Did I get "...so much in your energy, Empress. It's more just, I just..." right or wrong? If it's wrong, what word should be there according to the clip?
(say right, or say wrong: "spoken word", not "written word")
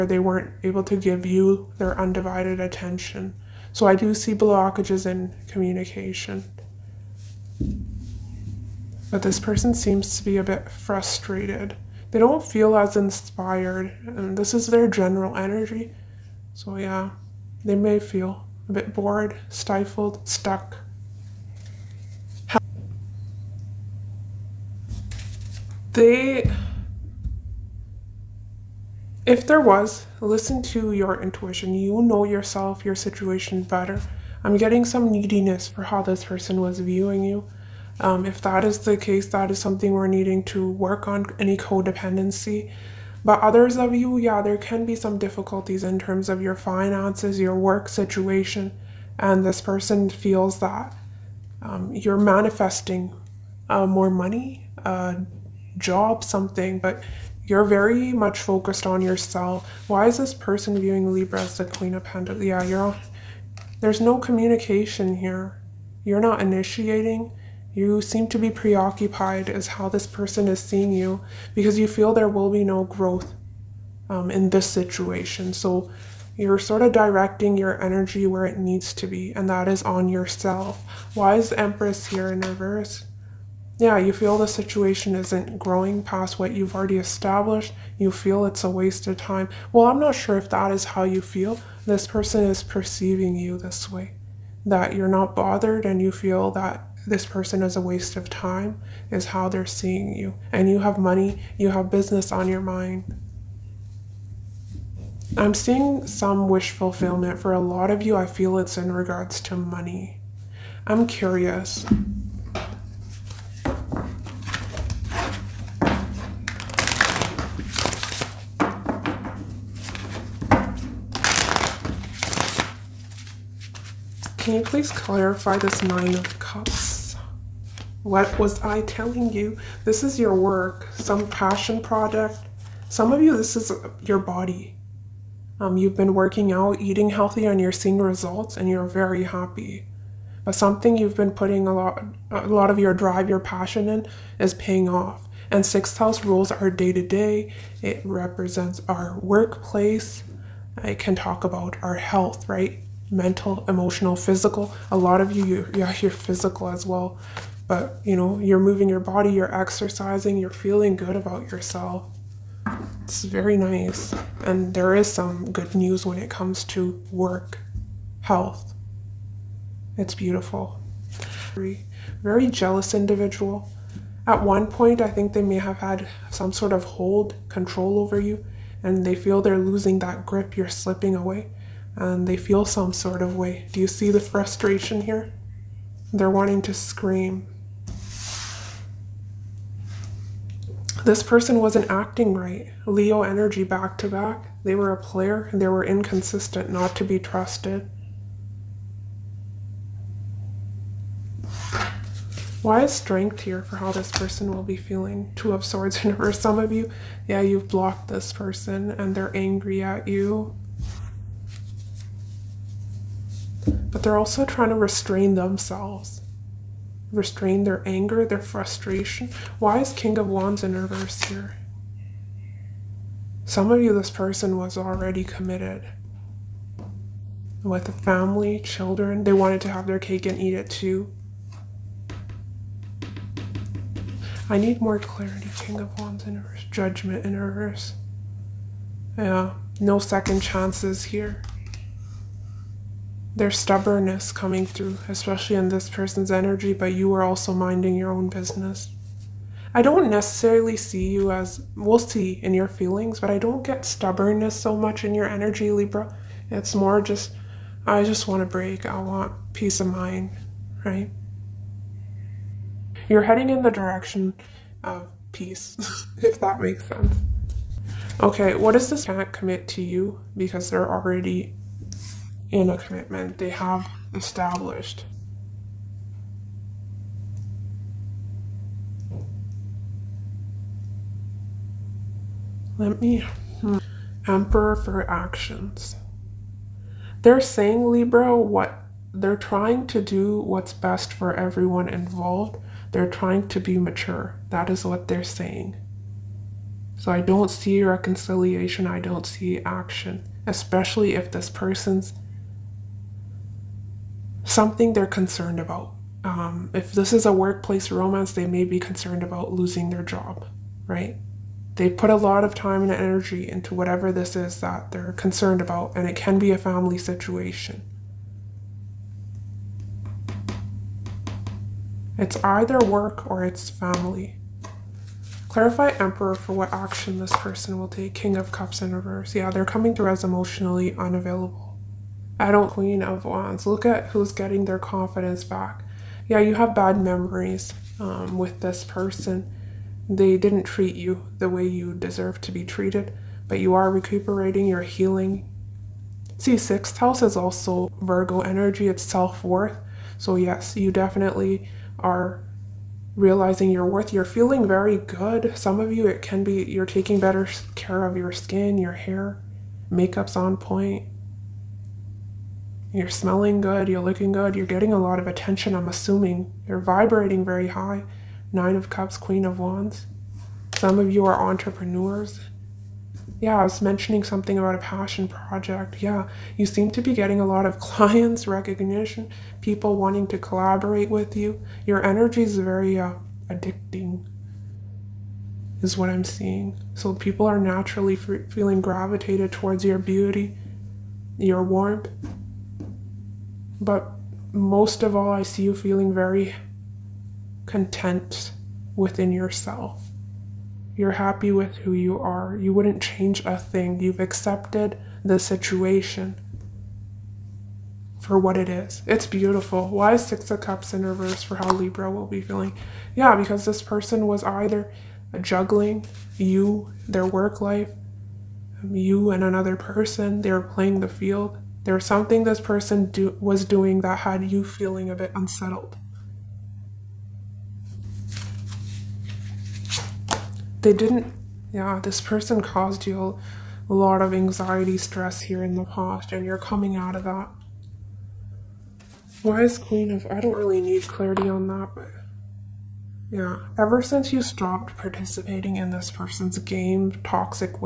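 wrong: "Libra", not "Empress".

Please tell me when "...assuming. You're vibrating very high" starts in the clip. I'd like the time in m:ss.
6:05.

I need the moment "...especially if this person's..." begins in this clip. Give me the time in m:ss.
5:00.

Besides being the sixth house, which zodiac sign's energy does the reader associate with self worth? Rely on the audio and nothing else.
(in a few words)
Virgo.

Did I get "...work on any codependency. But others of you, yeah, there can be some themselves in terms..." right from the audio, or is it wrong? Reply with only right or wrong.
wrong.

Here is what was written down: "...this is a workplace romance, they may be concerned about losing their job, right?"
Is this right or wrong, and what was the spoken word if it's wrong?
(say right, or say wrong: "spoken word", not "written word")
right.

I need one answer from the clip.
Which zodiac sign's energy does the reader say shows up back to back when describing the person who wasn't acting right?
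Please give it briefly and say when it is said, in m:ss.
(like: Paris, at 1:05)
Leo, at 3:12.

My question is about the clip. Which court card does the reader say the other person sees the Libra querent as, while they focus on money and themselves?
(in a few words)
Queen of Pentacles.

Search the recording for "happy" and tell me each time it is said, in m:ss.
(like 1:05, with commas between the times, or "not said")
2:19, 6:41.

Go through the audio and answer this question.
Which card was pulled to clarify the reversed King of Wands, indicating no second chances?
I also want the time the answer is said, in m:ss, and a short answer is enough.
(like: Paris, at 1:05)
Judgment, at 3:56.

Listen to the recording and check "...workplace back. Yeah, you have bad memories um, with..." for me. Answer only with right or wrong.
wrong.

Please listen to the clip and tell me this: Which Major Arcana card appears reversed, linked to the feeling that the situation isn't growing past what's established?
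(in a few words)
The Empress.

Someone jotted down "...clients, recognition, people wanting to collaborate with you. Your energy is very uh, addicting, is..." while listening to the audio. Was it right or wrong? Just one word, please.
right.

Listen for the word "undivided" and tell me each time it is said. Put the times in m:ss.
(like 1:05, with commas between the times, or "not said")
0:01.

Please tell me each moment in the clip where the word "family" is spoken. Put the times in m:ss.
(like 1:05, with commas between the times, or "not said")
3:47, 5:16, 5:23.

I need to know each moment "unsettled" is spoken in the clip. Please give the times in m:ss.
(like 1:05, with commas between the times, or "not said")
7:05.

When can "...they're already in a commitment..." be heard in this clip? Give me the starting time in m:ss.
4:30.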